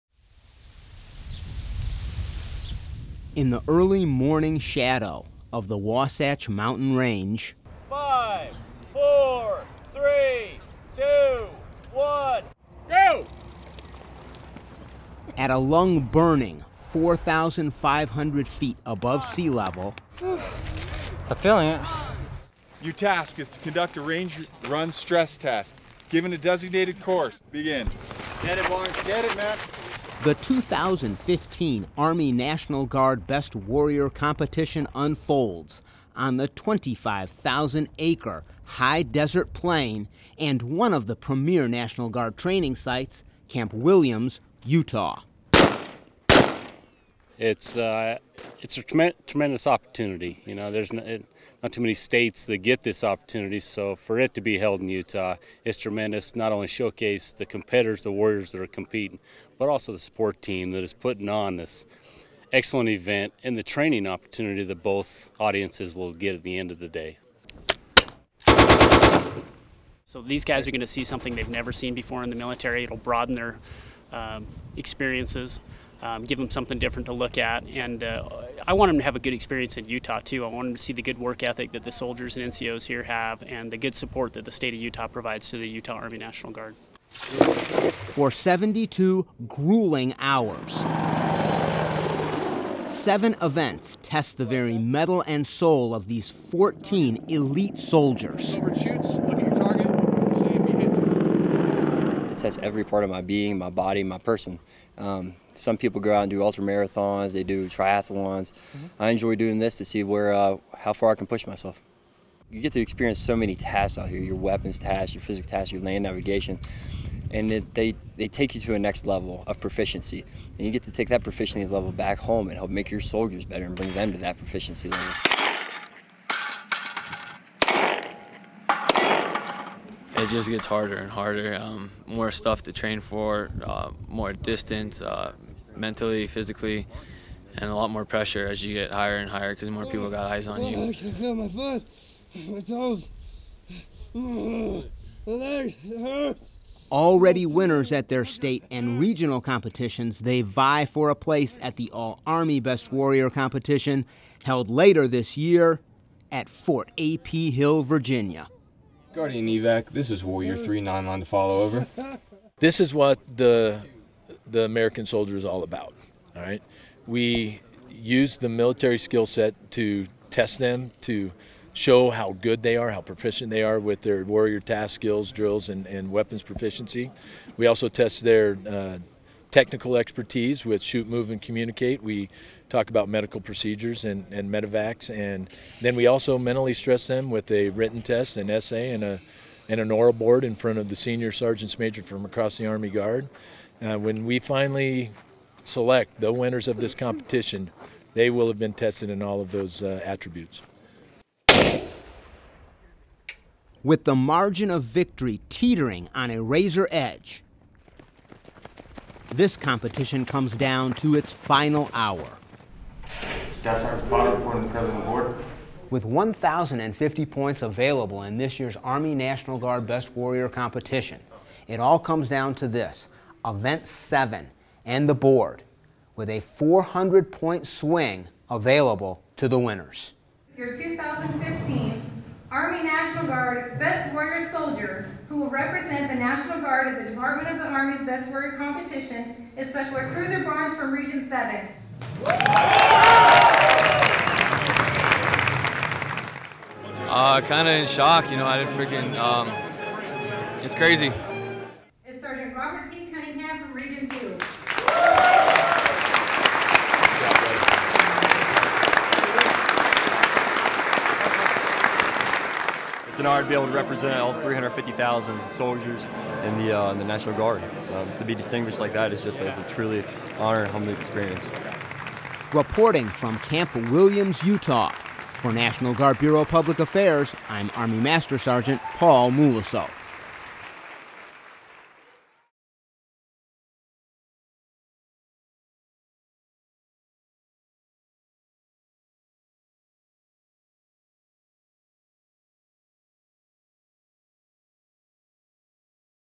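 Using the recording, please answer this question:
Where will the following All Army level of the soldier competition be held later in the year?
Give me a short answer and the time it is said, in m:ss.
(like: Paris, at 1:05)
Fort A.P. Hill, Virginia, at 2:36.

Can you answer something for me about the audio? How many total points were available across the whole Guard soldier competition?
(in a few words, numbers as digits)
1,050.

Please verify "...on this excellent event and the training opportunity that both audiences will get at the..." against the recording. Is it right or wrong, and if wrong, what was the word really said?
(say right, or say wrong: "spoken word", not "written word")
right.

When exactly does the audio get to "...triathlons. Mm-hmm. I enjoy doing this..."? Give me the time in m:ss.
1:47.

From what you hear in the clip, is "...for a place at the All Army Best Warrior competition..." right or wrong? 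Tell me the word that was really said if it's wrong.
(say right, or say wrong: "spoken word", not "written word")
right.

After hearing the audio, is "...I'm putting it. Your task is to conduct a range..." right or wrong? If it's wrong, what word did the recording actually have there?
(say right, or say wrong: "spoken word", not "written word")
wrong: "feeling", not "putting".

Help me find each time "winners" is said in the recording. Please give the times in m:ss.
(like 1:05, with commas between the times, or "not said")
2:27, 3:16, 3:49.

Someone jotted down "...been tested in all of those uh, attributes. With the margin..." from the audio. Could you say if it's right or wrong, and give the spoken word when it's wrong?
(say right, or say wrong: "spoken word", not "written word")
right.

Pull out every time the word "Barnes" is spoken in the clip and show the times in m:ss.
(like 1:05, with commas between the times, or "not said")
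0:28, 4:00.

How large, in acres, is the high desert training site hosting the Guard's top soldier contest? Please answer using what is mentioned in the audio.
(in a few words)
25,000 acres.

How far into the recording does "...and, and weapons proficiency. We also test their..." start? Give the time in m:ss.
2:55.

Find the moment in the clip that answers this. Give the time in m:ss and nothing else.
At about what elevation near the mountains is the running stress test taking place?
0:16.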